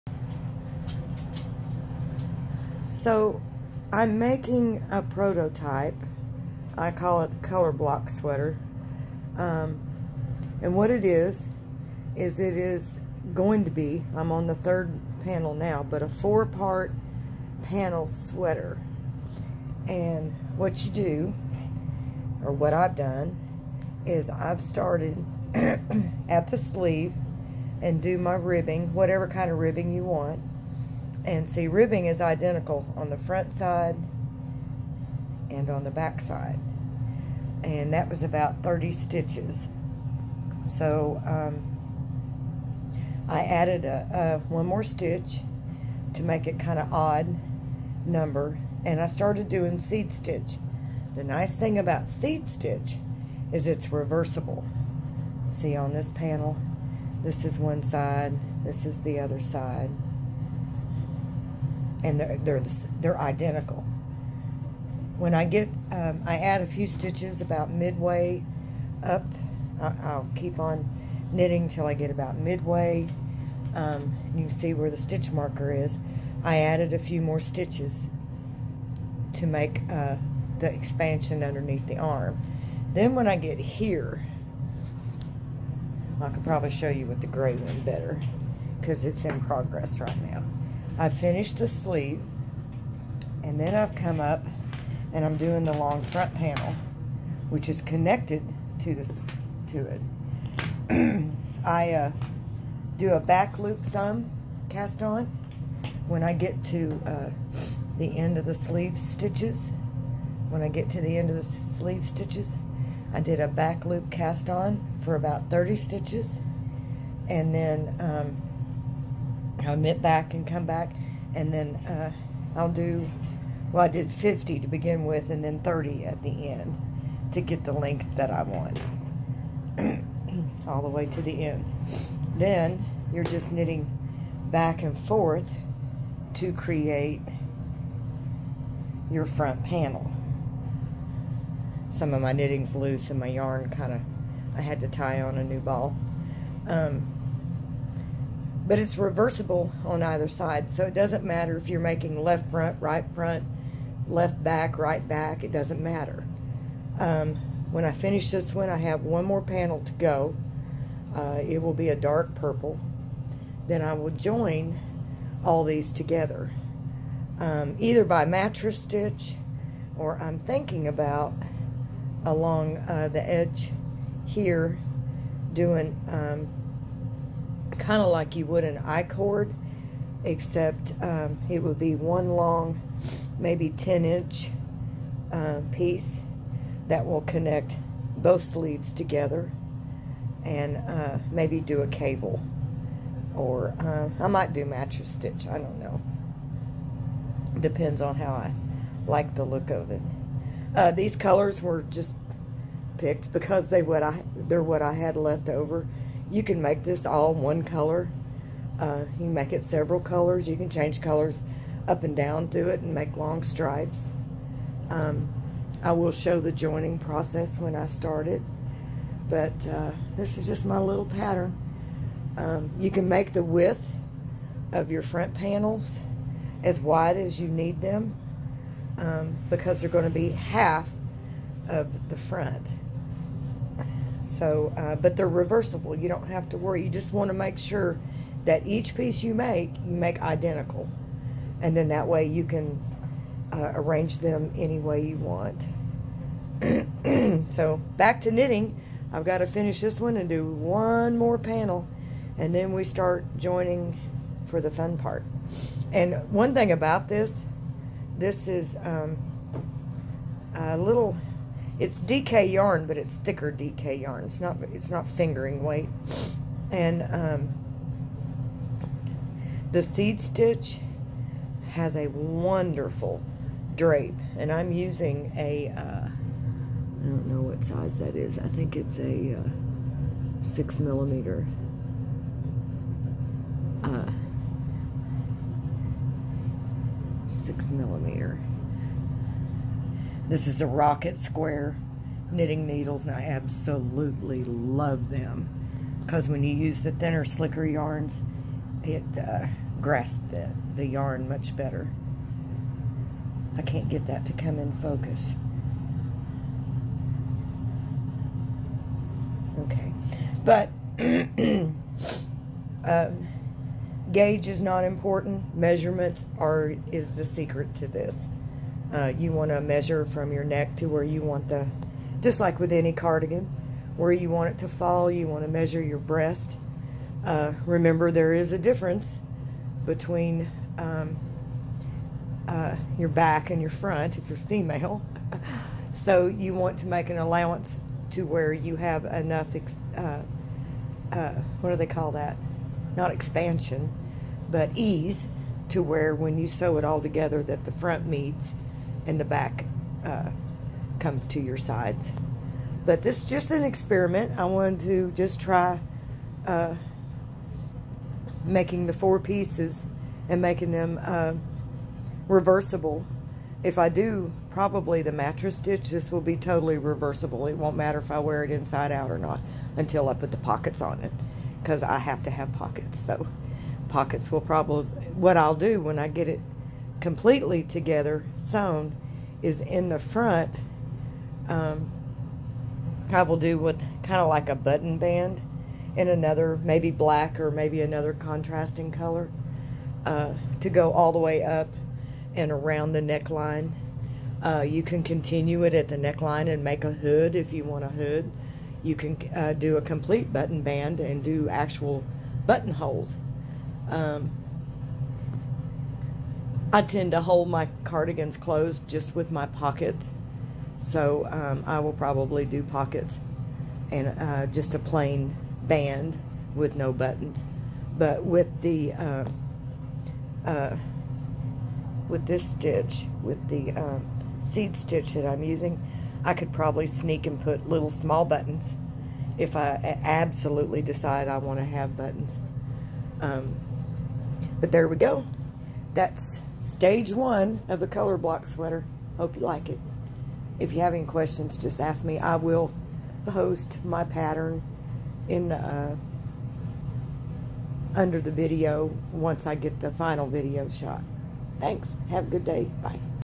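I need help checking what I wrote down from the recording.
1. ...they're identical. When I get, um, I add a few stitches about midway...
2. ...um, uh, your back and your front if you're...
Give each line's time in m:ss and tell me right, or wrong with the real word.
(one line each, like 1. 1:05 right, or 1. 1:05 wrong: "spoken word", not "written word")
1. 1:02 right
2. 5:30 right.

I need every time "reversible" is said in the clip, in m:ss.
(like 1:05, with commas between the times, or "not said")
0:53, 2:28, 3:55, 6:02, 6:06.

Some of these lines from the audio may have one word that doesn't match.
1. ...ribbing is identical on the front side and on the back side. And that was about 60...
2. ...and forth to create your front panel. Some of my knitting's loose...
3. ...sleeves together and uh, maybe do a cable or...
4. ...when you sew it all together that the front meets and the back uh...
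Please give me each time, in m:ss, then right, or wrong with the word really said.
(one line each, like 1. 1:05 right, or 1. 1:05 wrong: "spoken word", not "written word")
1. 0:31 wrong: "30", not "60"
2. 2:14 right
3. 3:08 right
4. 5:46 right.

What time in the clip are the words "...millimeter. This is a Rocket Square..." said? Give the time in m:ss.
4:47.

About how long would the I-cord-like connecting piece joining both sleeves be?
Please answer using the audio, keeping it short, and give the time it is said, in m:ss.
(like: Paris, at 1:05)
10 inches, at 3:03.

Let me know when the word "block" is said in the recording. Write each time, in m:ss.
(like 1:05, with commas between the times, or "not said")
0:07, 7:18.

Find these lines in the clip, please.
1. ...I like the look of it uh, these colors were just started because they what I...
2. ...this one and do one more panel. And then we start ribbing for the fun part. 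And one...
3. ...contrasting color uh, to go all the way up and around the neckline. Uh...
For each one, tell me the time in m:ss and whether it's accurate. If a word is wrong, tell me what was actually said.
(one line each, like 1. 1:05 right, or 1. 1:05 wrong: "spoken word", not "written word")
1. 3:18 wrong: "picked", not "started"
2. 4:09 wrong: "joining", not "ribbing"
3. 6:28 right.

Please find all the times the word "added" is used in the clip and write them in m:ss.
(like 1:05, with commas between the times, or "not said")
0:43, 1:16.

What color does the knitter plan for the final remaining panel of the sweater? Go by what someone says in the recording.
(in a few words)
dark purple.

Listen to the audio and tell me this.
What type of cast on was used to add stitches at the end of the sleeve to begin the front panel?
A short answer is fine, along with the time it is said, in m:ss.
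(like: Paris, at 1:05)
back loop thumb cast on, at 1:43.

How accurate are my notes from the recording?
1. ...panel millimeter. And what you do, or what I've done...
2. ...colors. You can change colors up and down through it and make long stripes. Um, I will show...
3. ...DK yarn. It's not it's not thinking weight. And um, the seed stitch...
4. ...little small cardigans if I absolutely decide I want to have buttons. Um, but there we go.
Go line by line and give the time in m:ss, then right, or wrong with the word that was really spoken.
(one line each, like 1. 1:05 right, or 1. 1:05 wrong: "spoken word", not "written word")
1. 0:17 wrong: "sweater", not "millimeter"
2. 3:29 right
3. 4:23 wrong: "fingering", not "thinking"
4. 7:07 wrong: "buttons", not "cardigans".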